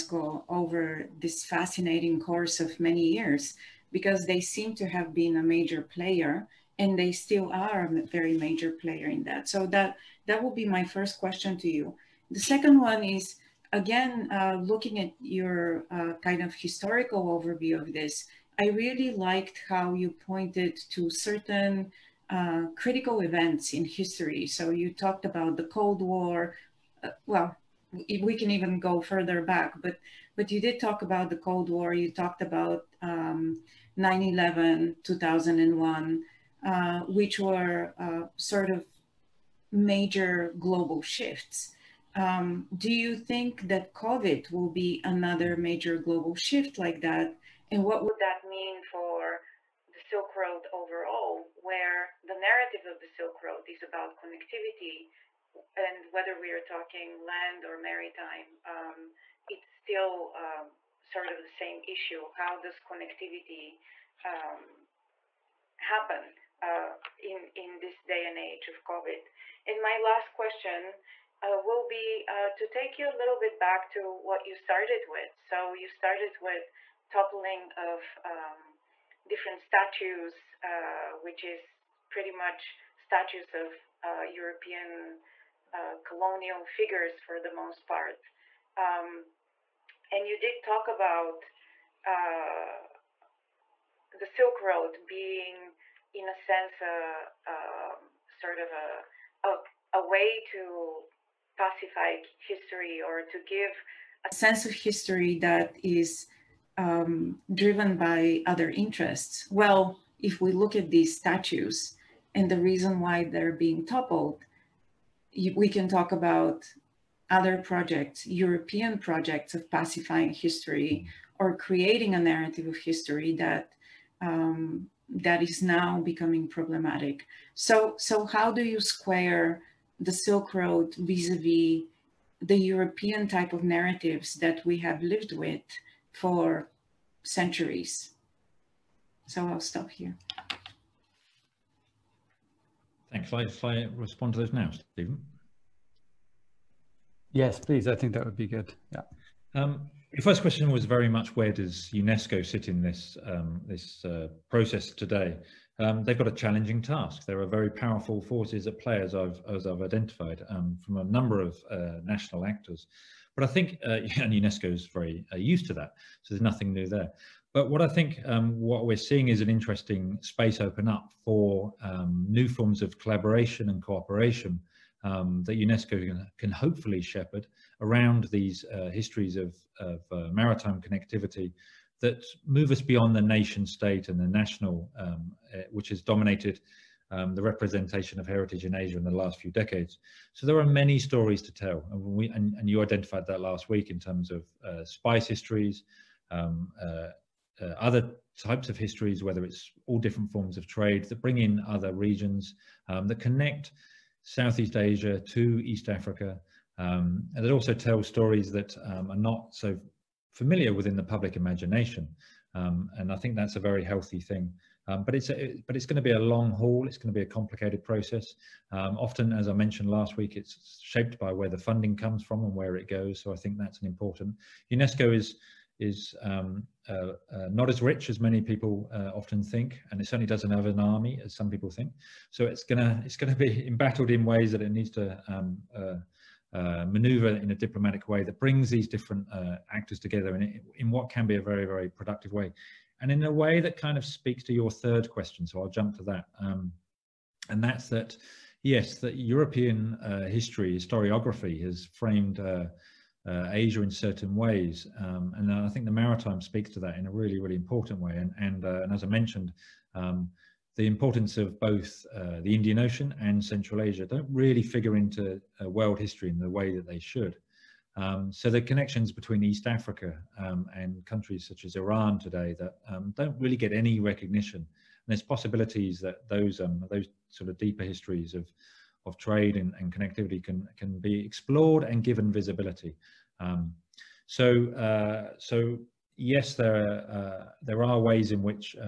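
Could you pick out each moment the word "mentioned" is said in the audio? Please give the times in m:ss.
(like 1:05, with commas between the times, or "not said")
3:39, 4:19.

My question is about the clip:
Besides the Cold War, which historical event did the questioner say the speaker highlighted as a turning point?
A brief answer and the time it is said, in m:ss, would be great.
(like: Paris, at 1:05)
9/11, at 0:33.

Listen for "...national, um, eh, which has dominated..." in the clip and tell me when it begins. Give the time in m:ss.
3:04.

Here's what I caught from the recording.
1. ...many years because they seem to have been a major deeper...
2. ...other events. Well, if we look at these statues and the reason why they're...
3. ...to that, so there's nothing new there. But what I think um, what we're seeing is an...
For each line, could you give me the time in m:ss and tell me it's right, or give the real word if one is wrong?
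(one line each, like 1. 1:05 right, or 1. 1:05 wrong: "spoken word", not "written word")
1. 0:02 wrong: "player", not "deeper"
2. 1:48 wrong: "interests", not "events"
3. 2:45 right.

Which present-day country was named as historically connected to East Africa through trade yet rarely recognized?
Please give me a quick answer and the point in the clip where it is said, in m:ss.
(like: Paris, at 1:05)
Iran, at 4:31.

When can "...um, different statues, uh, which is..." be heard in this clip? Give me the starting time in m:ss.
1:18.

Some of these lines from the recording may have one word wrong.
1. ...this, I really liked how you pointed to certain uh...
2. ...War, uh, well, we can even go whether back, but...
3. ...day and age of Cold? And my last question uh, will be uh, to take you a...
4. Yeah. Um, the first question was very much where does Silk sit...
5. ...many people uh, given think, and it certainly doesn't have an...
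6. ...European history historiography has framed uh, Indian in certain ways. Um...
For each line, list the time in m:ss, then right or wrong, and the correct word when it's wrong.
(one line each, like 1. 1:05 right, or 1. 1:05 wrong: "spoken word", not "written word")
1. 0:17 right
2. 0:26 wrong: "further", not "whether"
3. 1:08 wrong: "COVID", not "Cold"
4. 2:28 wrong: "UNESCO", not "Silk"
5. 3:48 wrong: "often", not "given"
6. 4:09 wrong: "Asia", not "Indian".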